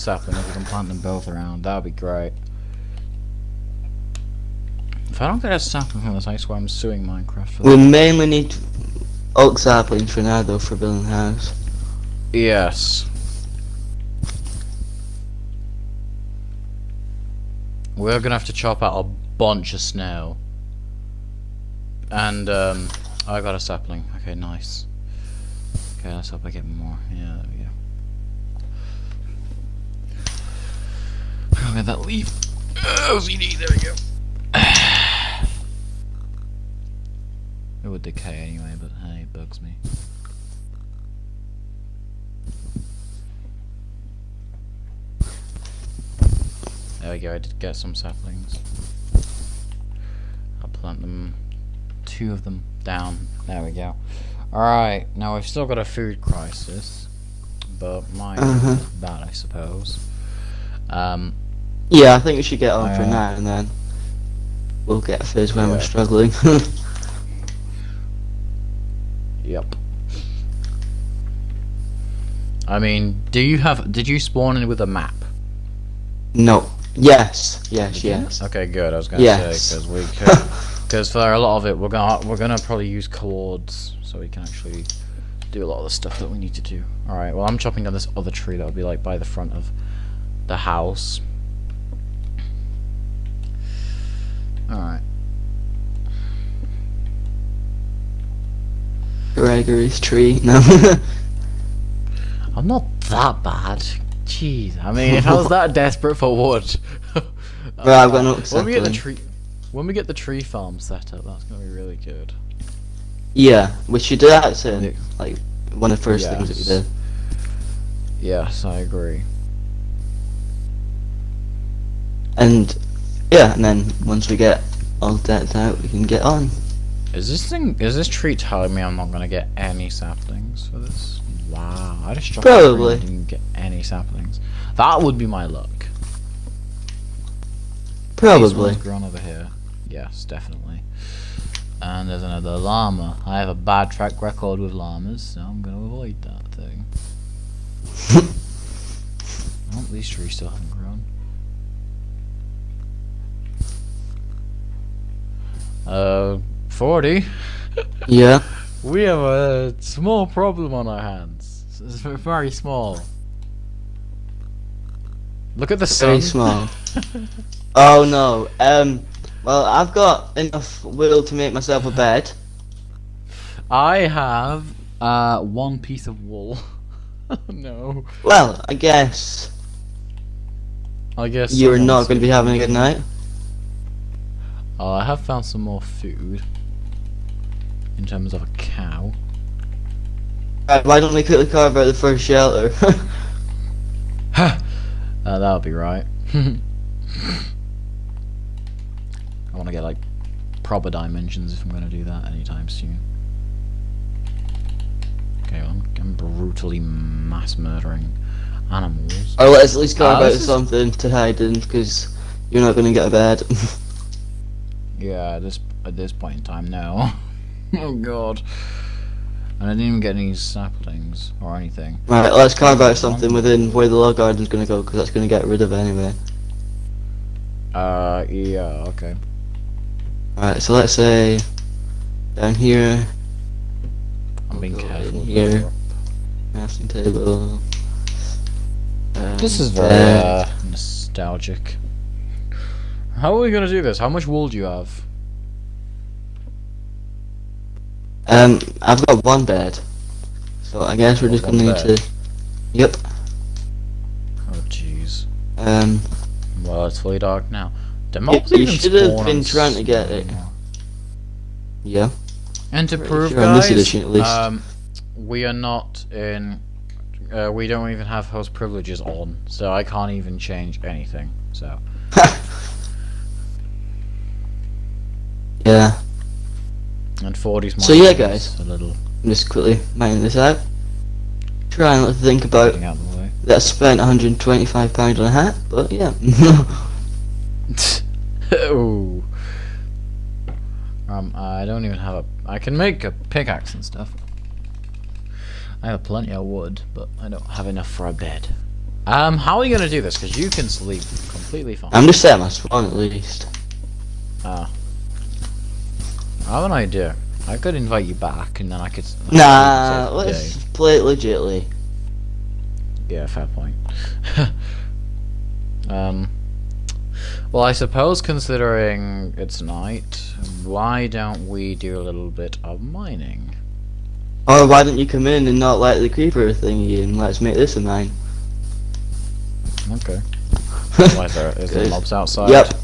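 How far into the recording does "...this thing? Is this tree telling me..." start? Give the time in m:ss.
2:07.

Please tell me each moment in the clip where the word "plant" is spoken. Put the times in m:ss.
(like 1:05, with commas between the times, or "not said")
0:00, 0:50.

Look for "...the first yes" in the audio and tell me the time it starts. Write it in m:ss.
1:55.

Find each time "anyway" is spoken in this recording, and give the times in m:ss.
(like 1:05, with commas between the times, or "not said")
0:38, 3:45.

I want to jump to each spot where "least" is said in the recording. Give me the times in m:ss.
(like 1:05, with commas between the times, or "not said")
3:29, 5:02.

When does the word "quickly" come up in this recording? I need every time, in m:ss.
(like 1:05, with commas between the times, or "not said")
3:11, 4:39.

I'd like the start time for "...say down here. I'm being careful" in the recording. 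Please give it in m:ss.
3:50.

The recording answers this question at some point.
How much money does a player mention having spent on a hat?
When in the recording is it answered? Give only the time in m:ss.
4:43.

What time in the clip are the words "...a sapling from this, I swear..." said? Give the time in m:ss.
0:05.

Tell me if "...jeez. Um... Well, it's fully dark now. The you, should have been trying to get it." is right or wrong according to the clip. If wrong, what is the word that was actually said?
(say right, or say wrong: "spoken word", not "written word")
right.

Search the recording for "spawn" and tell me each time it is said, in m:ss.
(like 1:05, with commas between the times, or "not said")
1:14, 5:02.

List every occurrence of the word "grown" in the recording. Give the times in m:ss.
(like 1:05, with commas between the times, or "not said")
2:18, 2:30.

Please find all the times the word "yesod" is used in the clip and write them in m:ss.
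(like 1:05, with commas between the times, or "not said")
not said.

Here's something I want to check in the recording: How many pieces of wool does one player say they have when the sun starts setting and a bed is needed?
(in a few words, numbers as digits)
1.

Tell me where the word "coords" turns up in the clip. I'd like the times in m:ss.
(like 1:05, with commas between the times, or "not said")
1:23.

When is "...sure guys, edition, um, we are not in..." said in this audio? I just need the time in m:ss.
4:23.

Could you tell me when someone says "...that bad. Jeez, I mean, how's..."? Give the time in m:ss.
1:43.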